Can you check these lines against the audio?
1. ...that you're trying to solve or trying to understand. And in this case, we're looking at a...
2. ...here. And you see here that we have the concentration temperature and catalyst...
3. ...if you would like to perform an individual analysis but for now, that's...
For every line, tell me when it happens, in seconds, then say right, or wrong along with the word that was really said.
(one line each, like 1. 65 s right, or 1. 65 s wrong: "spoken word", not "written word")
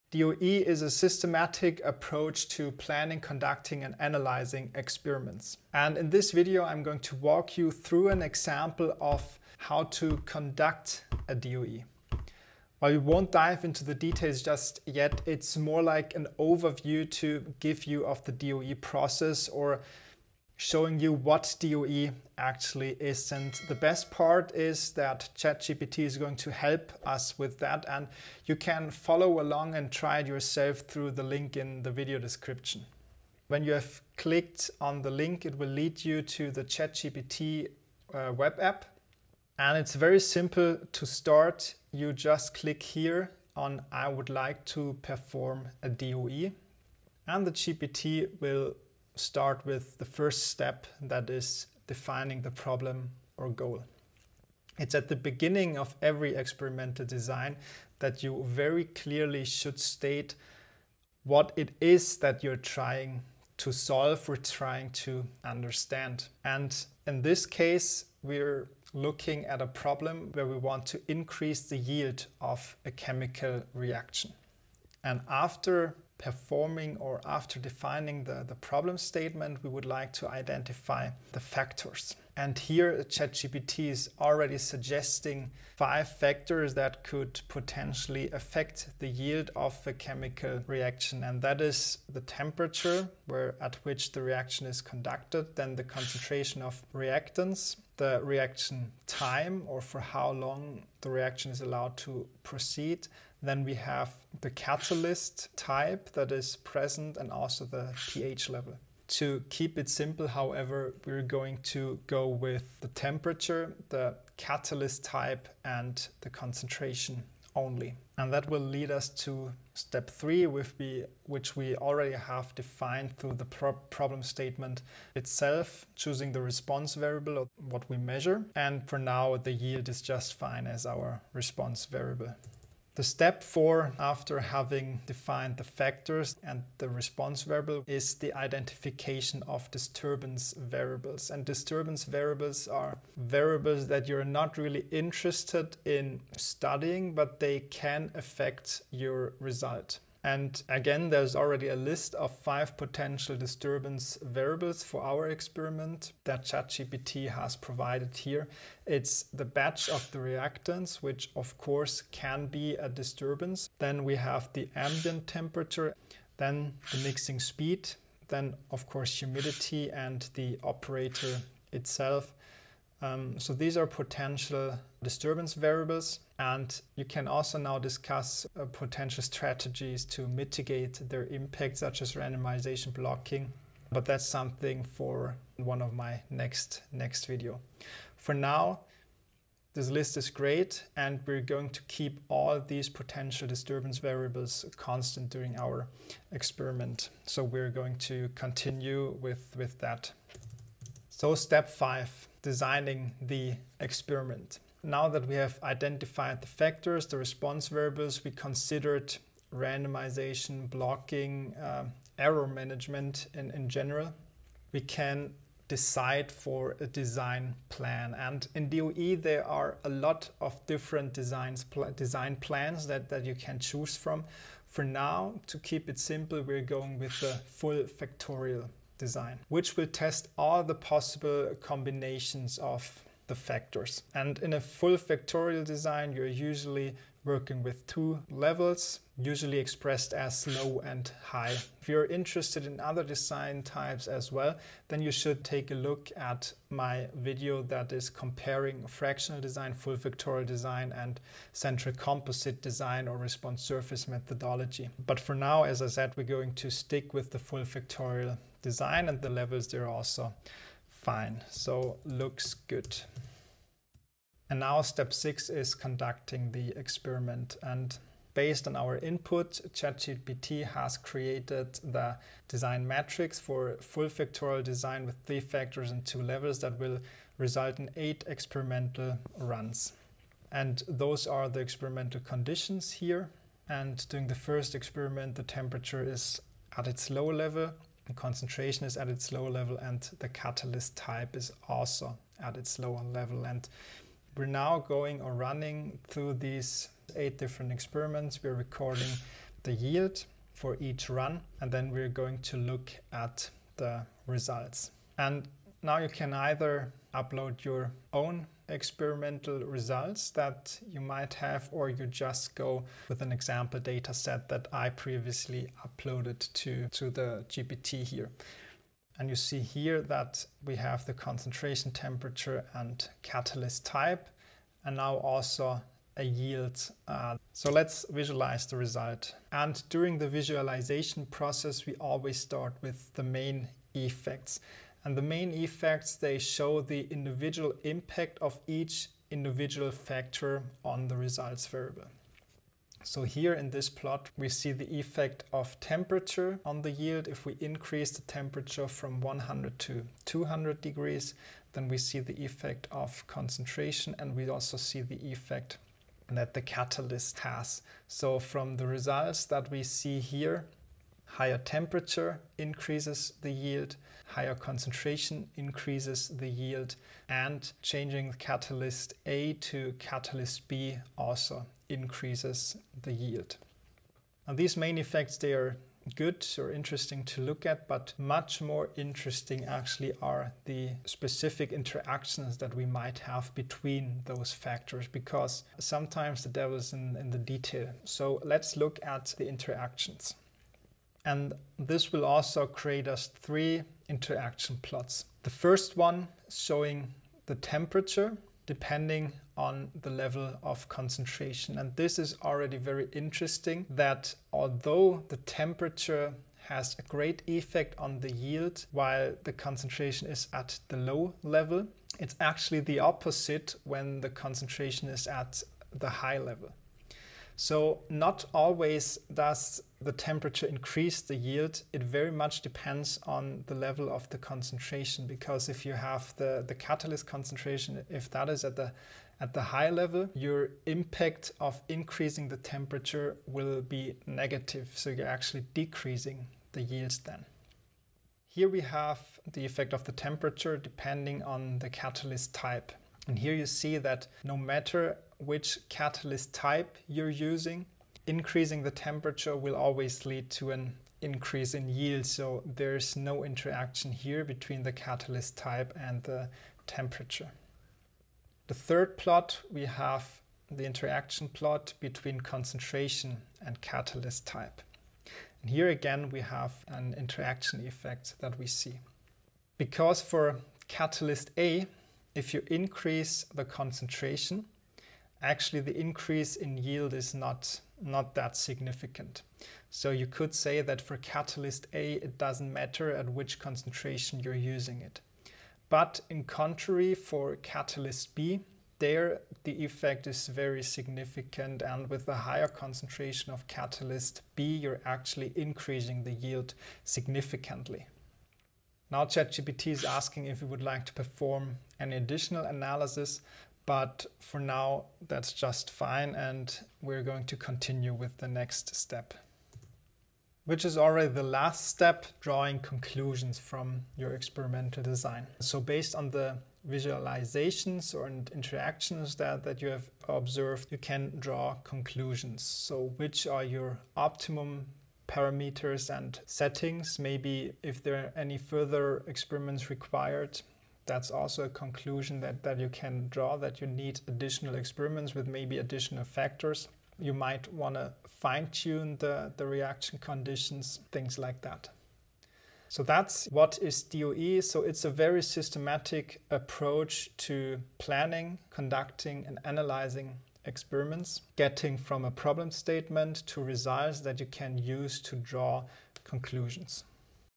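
1. 62 s right
2. 318 s right
3. 500 s wrong: "additional", not "individual".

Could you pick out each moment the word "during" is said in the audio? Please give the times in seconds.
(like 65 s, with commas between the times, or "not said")
195 s, 284 s, 329 s.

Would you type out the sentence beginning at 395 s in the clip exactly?
The first one showing the temperature depending on the level of concentration.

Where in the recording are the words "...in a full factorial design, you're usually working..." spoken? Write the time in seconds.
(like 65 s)
234 s.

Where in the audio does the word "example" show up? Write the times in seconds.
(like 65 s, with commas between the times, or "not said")
8 s, 313 s.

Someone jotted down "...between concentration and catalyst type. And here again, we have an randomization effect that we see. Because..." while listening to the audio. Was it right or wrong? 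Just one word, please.
wrong.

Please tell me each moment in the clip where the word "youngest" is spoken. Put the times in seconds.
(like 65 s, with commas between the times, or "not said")
not said.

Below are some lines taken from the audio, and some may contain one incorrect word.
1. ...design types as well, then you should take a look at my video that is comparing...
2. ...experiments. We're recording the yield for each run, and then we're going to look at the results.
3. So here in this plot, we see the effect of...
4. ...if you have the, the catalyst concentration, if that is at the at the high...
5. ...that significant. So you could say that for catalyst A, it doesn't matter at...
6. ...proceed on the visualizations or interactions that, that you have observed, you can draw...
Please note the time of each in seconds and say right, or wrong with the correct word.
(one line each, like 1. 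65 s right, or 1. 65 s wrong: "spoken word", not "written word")
1. 243 s right
2. 297 s right
3. 343 s right
4. 425 s right
5. 478 s right
6. 515 s wrong: "based", not "proceed".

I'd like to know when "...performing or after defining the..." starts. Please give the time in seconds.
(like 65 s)
76 s.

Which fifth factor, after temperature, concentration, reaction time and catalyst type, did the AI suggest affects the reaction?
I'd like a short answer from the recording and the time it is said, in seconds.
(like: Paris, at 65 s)
pH level, at 107 s.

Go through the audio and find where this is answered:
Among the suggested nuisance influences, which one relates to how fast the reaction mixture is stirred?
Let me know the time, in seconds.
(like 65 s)
166 s.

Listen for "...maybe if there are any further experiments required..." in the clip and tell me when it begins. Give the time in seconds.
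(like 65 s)
527 s.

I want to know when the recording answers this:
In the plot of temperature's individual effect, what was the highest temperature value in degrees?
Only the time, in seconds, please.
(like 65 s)
350 s.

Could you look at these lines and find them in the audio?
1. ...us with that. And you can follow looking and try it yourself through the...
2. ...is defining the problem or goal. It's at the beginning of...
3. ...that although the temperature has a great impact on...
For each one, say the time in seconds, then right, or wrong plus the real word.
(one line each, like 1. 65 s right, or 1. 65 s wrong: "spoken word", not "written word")
1. 27 s wrong: "along", not "looking"
2. 51 s right
3. 403 s wrong: "effect", not "impact".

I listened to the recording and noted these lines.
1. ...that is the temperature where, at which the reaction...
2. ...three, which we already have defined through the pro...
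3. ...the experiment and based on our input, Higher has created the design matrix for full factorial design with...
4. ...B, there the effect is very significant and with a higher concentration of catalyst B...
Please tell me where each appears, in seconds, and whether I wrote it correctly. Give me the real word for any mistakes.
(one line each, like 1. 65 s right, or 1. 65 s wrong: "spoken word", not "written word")
1. 91 s right
2. 120 s right
3. 266 s wrong: "ChatGPT", not "Higher"
4. 488 s right.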